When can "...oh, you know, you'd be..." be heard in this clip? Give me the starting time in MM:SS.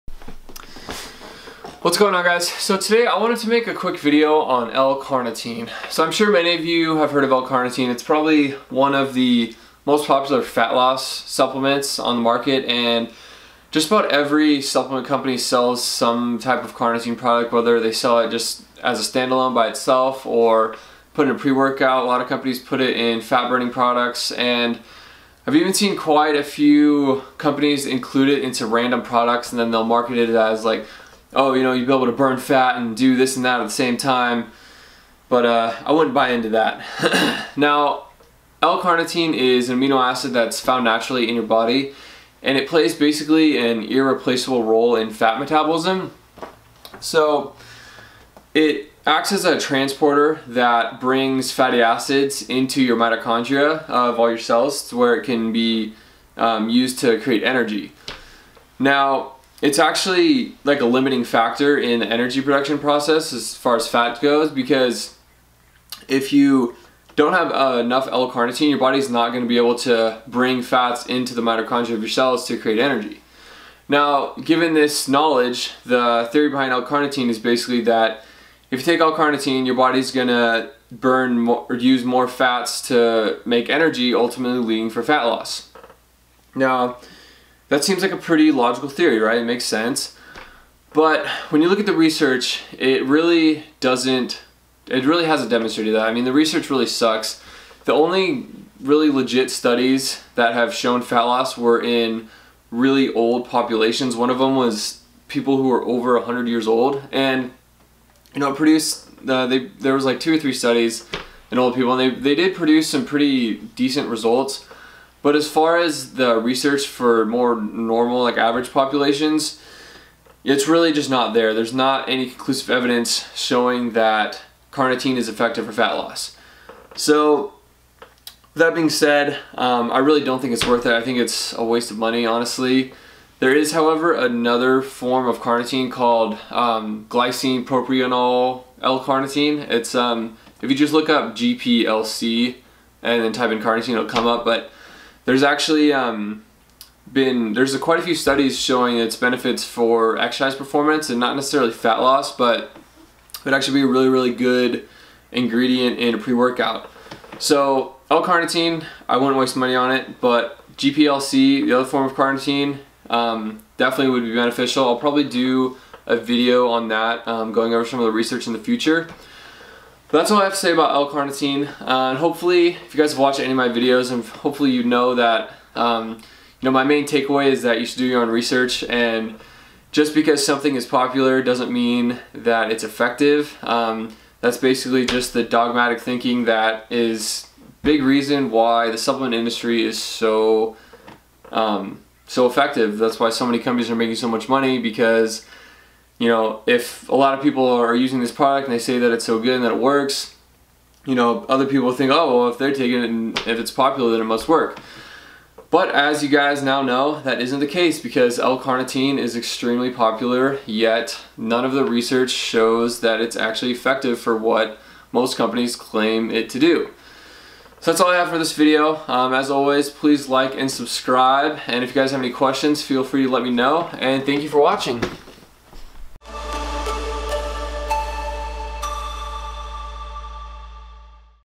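00:31.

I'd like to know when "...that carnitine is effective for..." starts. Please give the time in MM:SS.
02:03.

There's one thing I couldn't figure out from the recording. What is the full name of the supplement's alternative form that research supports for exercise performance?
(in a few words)
glycine propionyl L-carnitine.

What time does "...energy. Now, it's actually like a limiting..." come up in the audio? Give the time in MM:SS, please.
00:57.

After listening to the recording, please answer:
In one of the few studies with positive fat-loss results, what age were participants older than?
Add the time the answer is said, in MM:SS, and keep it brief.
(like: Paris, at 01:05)
100, at 01:46.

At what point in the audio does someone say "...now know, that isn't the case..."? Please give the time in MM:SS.
03:26.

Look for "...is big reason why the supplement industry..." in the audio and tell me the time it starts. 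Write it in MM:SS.
03:06.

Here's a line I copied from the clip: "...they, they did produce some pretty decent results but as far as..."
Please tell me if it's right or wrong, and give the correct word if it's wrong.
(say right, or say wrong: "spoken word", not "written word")
right.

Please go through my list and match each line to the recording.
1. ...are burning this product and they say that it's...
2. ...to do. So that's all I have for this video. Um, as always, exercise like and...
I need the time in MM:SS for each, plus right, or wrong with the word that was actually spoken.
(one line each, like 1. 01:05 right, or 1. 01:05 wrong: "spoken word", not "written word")
1. 03:17 wrong: "using", not "burning"
2. 03:36 wrong: "please", not "exercise".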